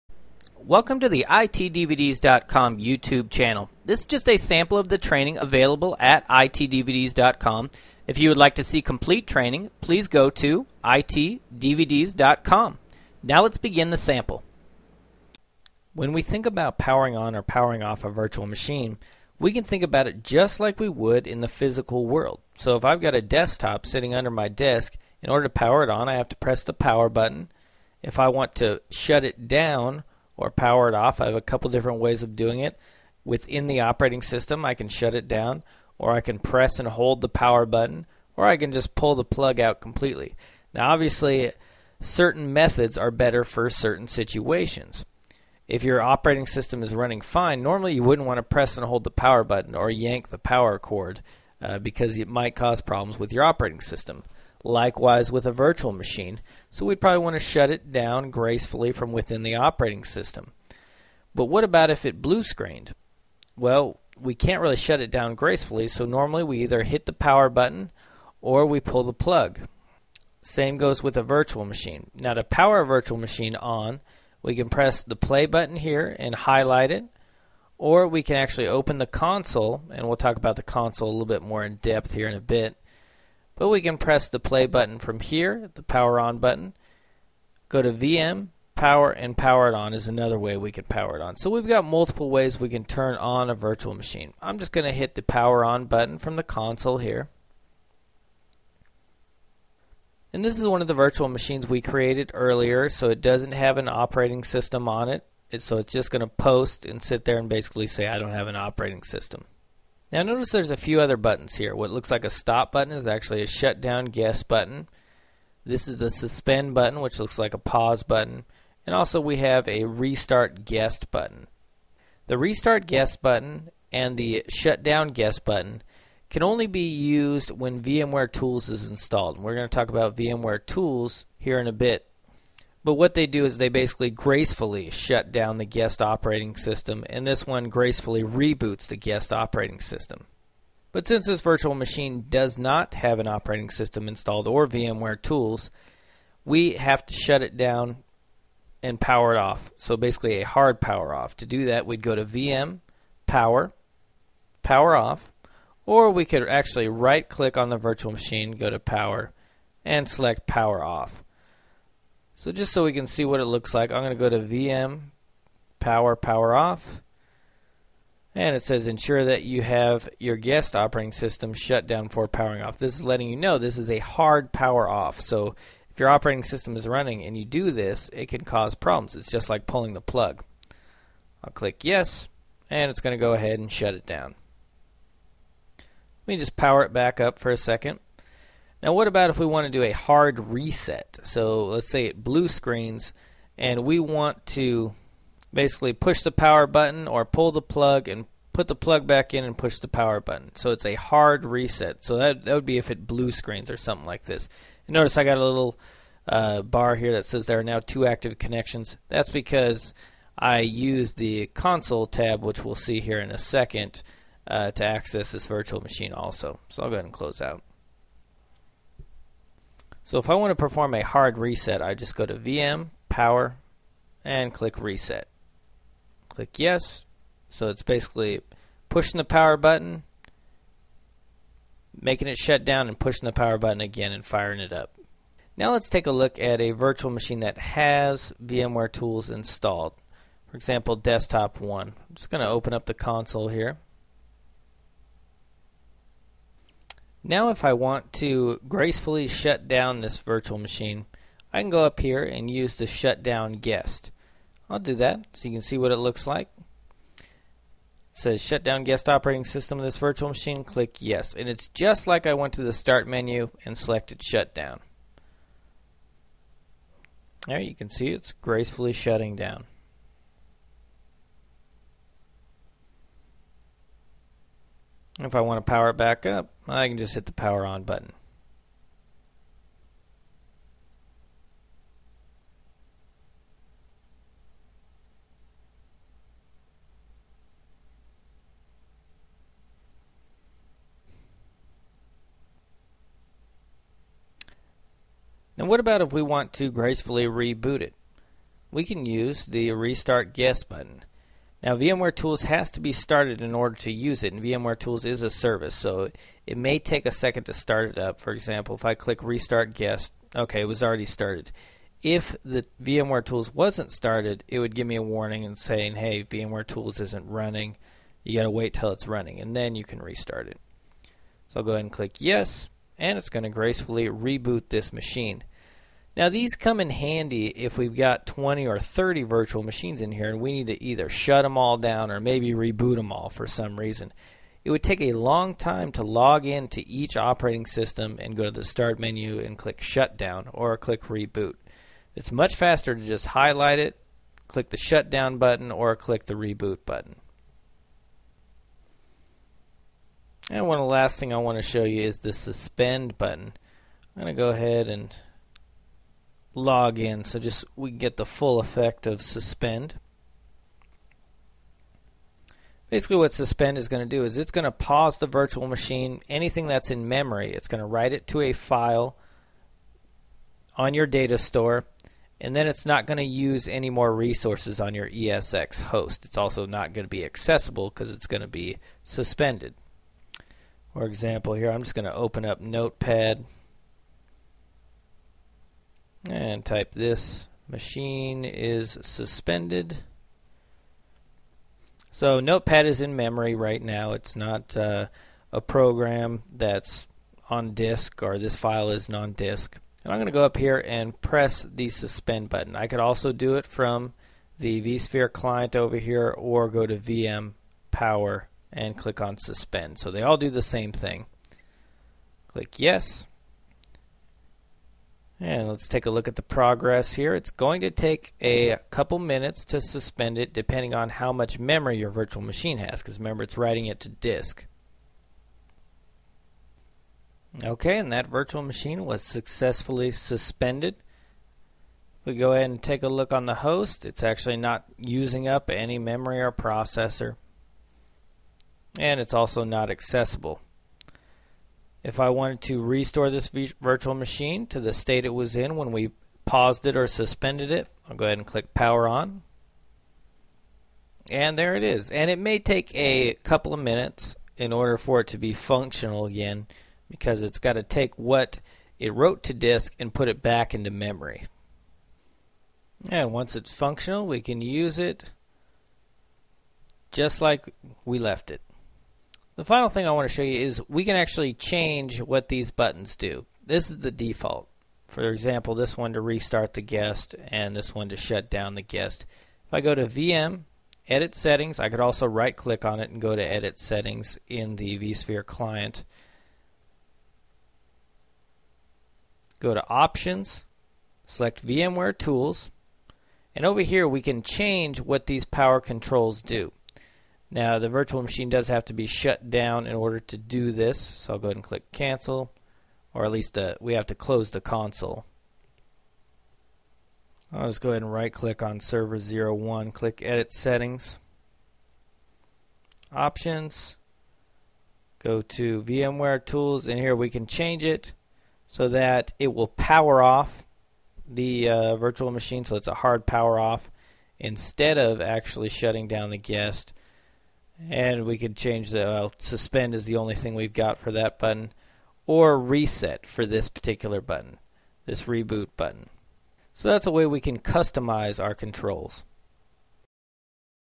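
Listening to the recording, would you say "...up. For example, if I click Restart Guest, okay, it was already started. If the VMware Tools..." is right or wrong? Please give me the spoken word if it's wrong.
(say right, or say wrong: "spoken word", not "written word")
right.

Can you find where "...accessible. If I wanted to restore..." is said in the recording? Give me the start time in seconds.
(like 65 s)
439 s.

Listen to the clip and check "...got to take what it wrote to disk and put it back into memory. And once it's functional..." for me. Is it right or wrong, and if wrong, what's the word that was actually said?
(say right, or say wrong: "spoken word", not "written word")
right.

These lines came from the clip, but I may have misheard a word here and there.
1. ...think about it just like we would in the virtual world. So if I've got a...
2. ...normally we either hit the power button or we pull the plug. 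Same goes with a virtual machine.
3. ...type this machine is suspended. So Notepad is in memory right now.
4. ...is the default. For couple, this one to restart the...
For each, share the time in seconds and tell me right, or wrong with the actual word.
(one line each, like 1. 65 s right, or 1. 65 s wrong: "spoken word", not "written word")
1. 19 s wrong: "physical", not "virtual"
2. 66 s right
3. 386 s right
4. 473 s wrong: "example", not "couple".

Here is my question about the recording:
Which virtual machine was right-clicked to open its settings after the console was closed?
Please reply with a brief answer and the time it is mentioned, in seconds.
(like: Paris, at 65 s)
server 01, at 508 s.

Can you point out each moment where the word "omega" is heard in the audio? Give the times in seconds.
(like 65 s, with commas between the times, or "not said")
not said.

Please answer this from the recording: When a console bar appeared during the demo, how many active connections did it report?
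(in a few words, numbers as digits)
2.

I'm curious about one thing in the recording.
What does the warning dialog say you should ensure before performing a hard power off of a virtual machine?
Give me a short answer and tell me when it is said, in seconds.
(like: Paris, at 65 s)
guest operating system shut down, at 170 s.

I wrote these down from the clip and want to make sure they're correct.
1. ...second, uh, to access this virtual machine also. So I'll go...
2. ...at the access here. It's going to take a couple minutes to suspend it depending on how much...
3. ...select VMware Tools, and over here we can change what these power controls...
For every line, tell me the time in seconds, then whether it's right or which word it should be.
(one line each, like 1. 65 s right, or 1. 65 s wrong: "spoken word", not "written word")
1. 213 s right
2. 416 s wrong: "progress", not "access"
3. 491 s right.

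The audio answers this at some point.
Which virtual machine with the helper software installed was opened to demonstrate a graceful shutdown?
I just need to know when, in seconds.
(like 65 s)
240 s.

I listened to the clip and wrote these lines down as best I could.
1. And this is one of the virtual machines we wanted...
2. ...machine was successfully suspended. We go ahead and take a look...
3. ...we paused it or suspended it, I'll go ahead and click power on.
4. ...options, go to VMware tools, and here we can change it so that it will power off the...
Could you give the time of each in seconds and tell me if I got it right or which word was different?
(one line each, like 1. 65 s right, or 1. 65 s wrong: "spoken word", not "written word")
1. 100 s wrong: "created", not "wanted"
2. 428 s right
3. 445 s right
4. 513 s right.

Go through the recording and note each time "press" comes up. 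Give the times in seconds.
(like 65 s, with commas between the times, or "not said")
26 s, 36 s, 48 s, 74 s, 83 s, 401 s.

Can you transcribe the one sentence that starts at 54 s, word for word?
Likewise with a virtual machine, so we'd probably want to shut it down gracefully from within the operating system.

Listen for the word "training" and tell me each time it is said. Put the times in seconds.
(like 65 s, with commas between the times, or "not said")
4 s, 9 s.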